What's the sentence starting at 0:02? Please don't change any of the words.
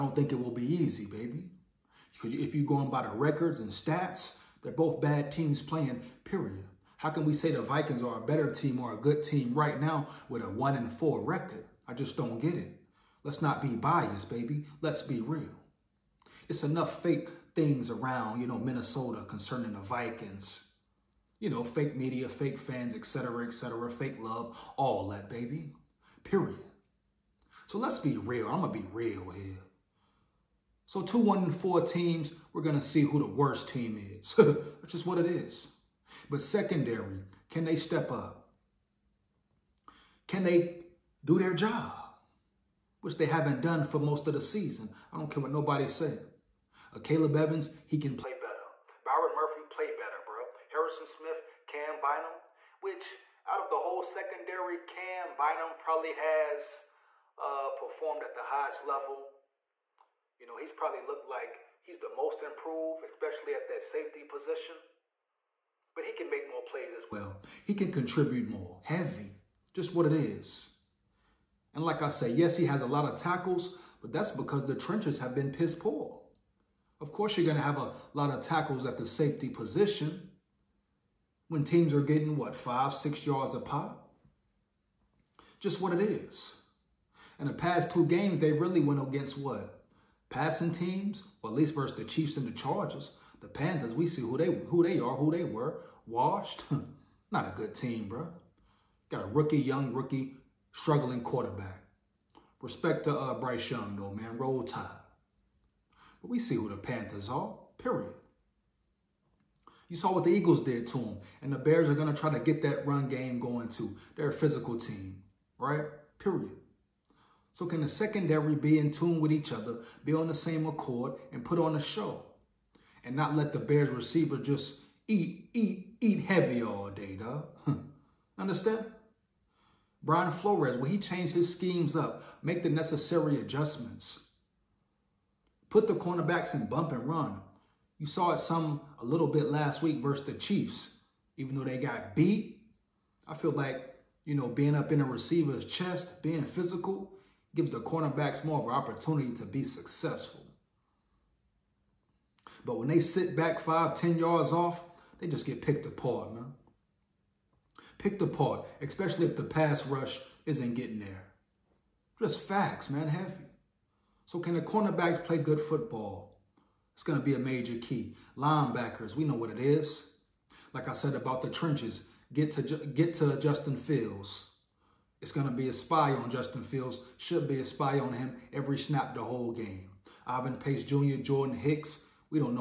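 Because if you're going by the records and stats, they're both bad teams playing, period.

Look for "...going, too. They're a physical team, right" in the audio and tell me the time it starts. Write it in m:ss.
1:53.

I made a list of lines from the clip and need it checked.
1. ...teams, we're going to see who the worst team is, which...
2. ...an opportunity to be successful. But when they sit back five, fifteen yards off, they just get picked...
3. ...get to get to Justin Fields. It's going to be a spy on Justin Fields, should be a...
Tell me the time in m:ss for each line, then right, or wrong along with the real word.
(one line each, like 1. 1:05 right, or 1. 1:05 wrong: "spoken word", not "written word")
1. 0:31 right
2. 2:28 wrong: "ten", not "fifteen"
3. 2:52 right.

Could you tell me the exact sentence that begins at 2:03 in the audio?
And not let the Bears receiver just eat, eat, eat heavy all day, dog.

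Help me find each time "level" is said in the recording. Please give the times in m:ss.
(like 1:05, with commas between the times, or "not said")
0:58.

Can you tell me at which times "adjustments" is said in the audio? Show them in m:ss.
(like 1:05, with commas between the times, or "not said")
2:13.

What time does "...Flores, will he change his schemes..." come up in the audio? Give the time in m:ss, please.
2:10.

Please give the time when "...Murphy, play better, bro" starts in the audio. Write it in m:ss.
0:49.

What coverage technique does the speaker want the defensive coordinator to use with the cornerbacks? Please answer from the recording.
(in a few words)
Bump and run.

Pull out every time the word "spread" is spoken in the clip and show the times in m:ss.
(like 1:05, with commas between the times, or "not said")
not said.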